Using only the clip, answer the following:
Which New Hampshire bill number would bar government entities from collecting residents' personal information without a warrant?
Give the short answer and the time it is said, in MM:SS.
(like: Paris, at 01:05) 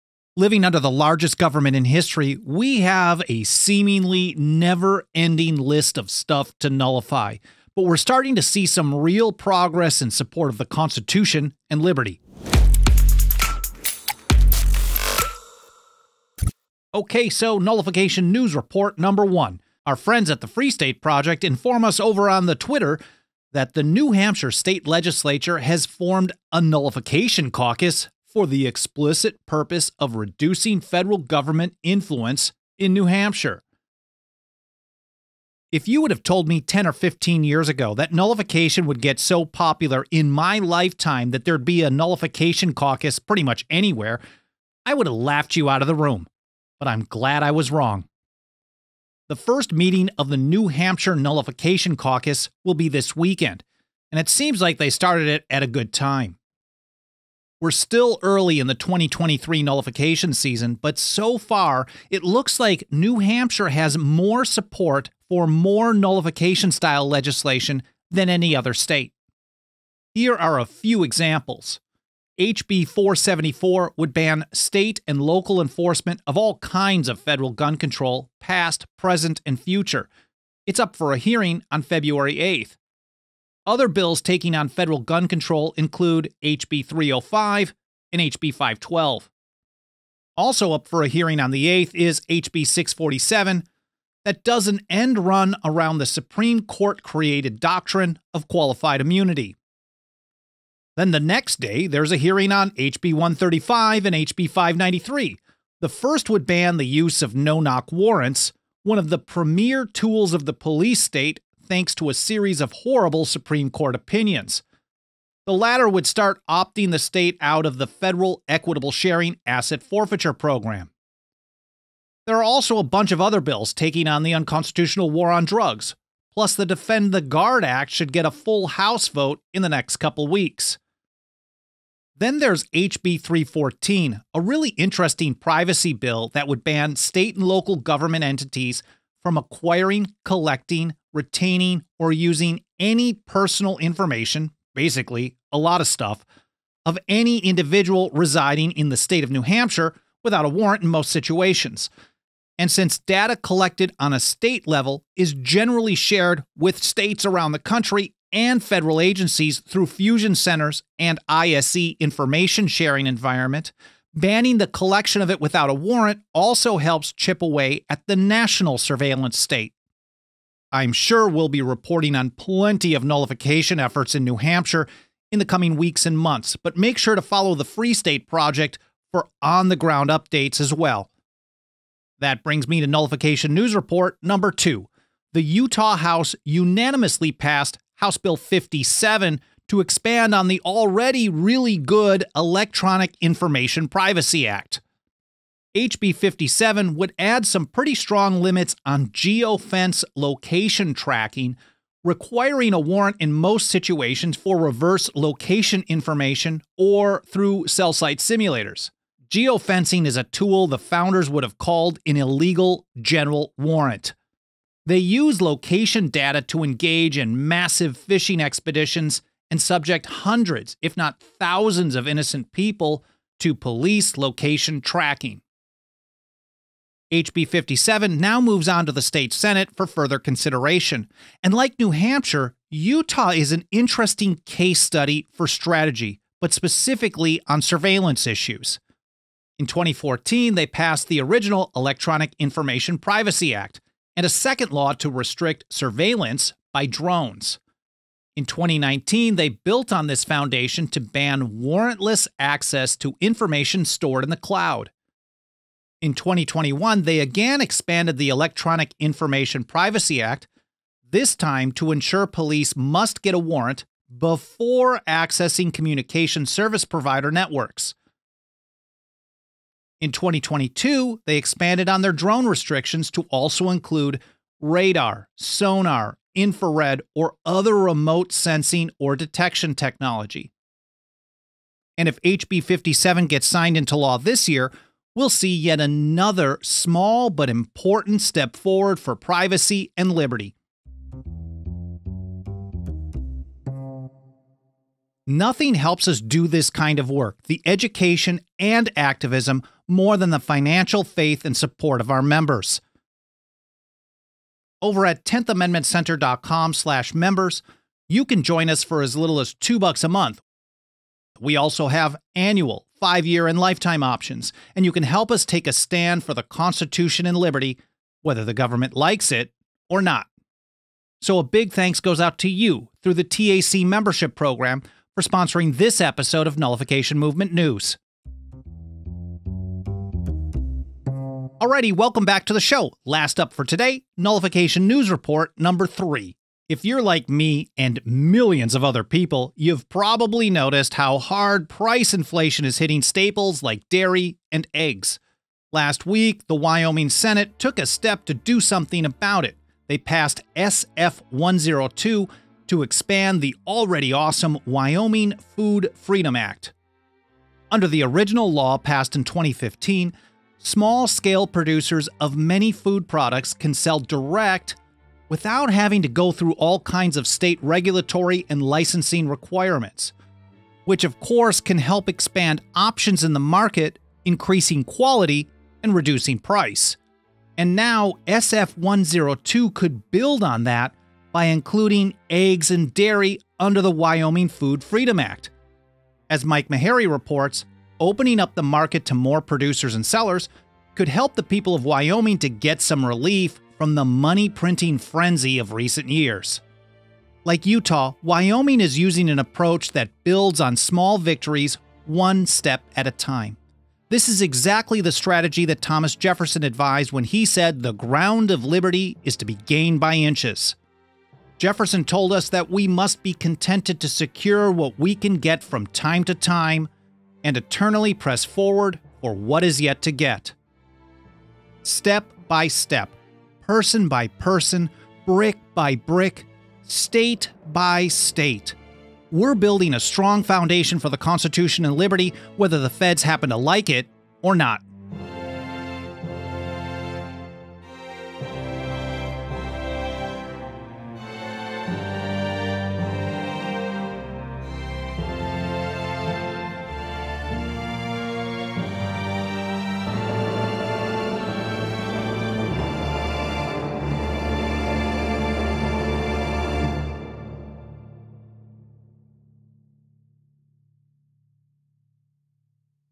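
HB 314, at 02:12.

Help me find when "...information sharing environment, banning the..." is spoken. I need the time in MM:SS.
02:41.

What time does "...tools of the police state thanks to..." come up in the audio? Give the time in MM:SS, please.
01:49.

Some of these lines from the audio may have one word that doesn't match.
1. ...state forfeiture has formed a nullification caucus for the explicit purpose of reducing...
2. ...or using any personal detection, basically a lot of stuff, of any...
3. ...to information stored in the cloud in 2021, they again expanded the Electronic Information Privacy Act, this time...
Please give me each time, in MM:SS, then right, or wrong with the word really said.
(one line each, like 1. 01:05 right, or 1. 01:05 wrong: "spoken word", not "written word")
1. 00:24 wrong: "legislature", not "forfeiture"
2. 02:21 wrong: "information", not "detection"
3. 04:12 right.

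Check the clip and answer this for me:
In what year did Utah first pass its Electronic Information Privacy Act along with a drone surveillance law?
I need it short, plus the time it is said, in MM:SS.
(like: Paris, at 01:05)
2014, at 03:59.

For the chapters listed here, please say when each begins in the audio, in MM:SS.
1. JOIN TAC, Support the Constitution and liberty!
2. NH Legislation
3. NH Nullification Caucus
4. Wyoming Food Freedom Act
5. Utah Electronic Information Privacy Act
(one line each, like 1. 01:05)
1. 04:50
2. 01:09
3. 00:16
4. 05:28
5. 03:06.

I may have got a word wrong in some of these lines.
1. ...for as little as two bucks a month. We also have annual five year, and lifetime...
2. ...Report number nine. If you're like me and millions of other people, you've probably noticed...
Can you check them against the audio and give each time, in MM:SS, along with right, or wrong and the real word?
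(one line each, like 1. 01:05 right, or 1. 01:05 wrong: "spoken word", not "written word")
1. 05:08 right
2. 05:35 wrong: "three", not "nine".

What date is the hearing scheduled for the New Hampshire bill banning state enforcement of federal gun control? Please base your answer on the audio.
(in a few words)
February 8th.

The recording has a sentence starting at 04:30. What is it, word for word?
In 2022, they expanded on their drone restrictions to also include radar, sonar, infrared, or other remote sensing or detection technology.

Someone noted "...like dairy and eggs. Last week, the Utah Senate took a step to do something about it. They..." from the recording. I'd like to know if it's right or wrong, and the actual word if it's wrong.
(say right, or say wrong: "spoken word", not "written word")
wrong: "Wyoming", not "Utah".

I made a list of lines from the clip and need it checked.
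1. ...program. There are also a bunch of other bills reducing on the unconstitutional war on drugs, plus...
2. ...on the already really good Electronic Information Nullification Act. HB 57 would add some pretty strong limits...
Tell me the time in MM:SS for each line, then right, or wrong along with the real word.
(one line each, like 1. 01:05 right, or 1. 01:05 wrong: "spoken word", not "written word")
1. 02:00 wrong: "taking", not "reducing"
2. 03:10 wrong: "Privacy", not "Nullification".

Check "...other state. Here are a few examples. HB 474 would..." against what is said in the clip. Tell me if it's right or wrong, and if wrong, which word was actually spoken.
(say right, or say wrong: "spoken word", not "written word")
right.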